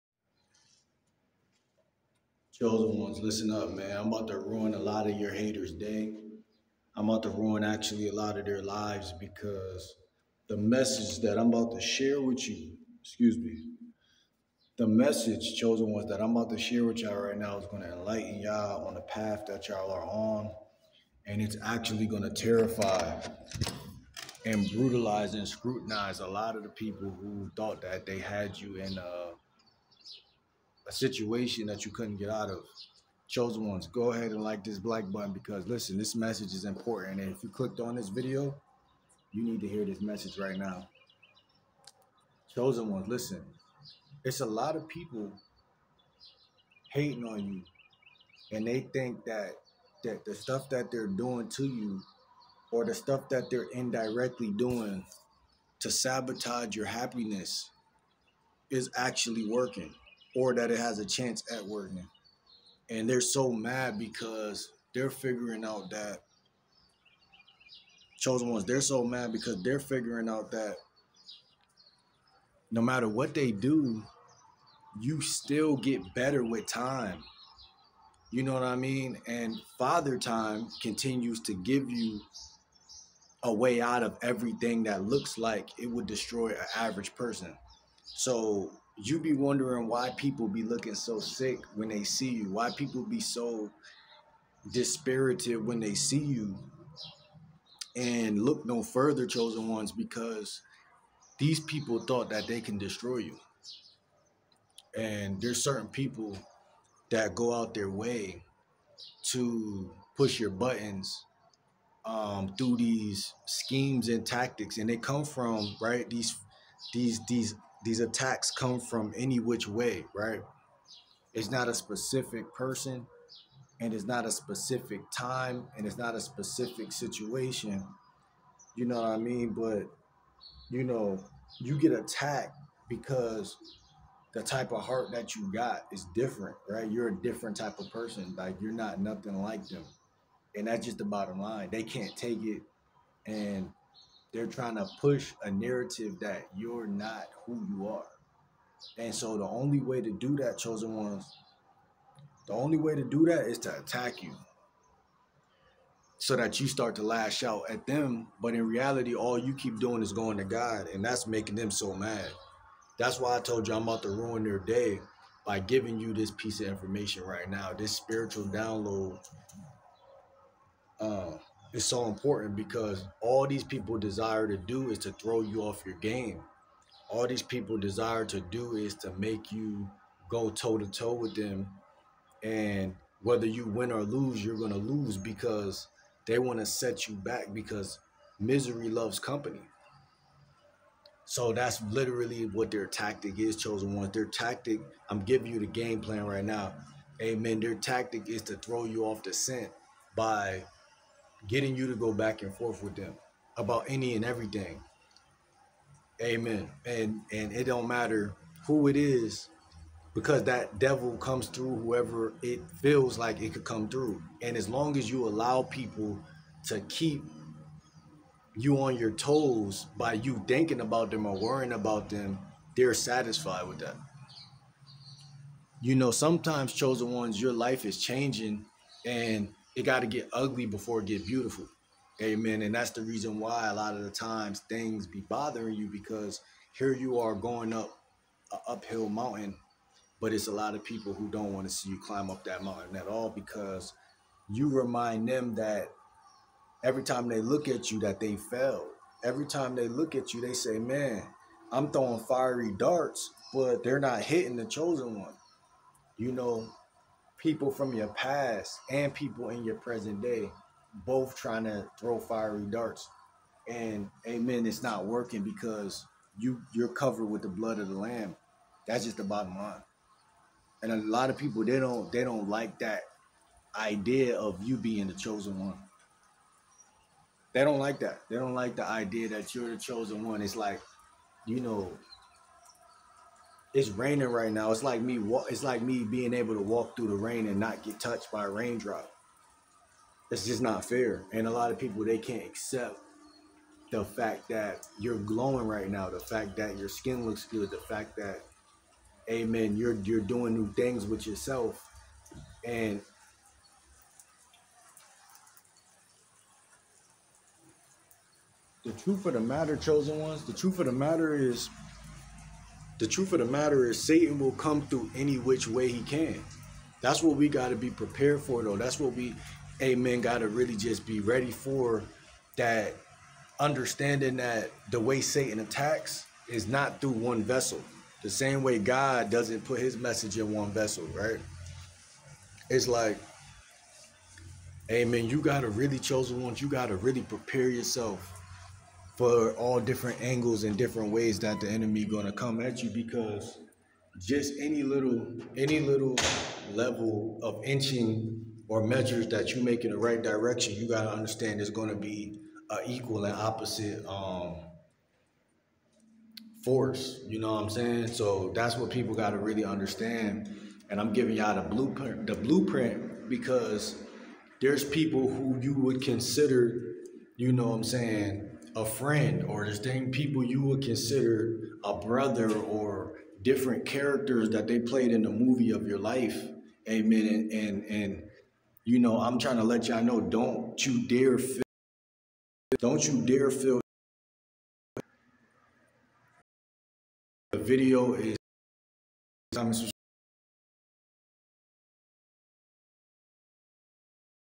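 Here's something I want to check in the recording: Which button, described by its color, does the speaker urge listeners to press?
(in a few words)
black button.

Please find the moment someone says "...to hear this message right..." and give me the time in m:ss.
0:39.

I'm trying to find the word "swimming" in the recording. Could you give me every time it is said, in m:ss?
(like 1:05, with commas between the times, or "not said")
not said.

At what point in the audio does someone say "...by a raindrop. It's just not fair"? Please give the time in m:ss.
4:48.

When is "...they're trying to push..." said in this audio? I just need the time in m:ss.
2:24.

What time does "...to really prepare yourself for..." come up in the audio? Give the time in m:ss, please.
5:36.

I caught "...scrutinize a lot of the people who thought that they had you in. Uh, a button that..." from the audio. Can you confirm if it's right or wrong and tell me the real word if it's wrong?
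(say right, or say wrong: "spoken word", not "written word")
wrong: "situation", not "button".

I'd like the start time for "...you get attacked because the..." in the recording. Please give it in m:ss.
2:11.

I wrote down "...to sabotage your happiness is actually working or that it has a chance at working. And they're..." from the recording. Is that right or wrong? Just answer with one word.
right.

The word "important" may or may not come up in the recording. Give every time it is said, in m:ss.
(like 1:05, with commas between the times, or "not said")
0:36, 2:52.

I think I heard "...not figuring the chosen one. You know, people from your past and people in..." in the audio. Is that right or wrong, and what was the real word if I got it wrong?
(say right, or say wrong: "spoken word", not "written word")
wrong: "hitting", not "figuring".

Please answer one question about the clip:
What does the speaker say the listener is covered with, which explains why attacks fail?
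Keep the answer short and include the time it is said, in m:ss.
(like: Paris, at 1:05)
blood of the lamb, at 4:27.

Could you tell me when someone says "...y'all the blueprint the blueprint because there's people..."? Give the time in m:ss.
6:01.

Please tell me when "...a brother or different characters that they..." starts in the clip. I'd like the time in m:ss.
6:11.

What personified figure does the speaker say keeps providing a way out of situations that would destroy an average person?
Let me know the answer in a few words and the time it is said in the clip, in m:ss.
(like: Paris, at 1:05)
Father Time, at 1:19.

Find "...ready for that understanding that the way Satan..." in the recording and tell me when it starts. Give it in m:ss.
5:21.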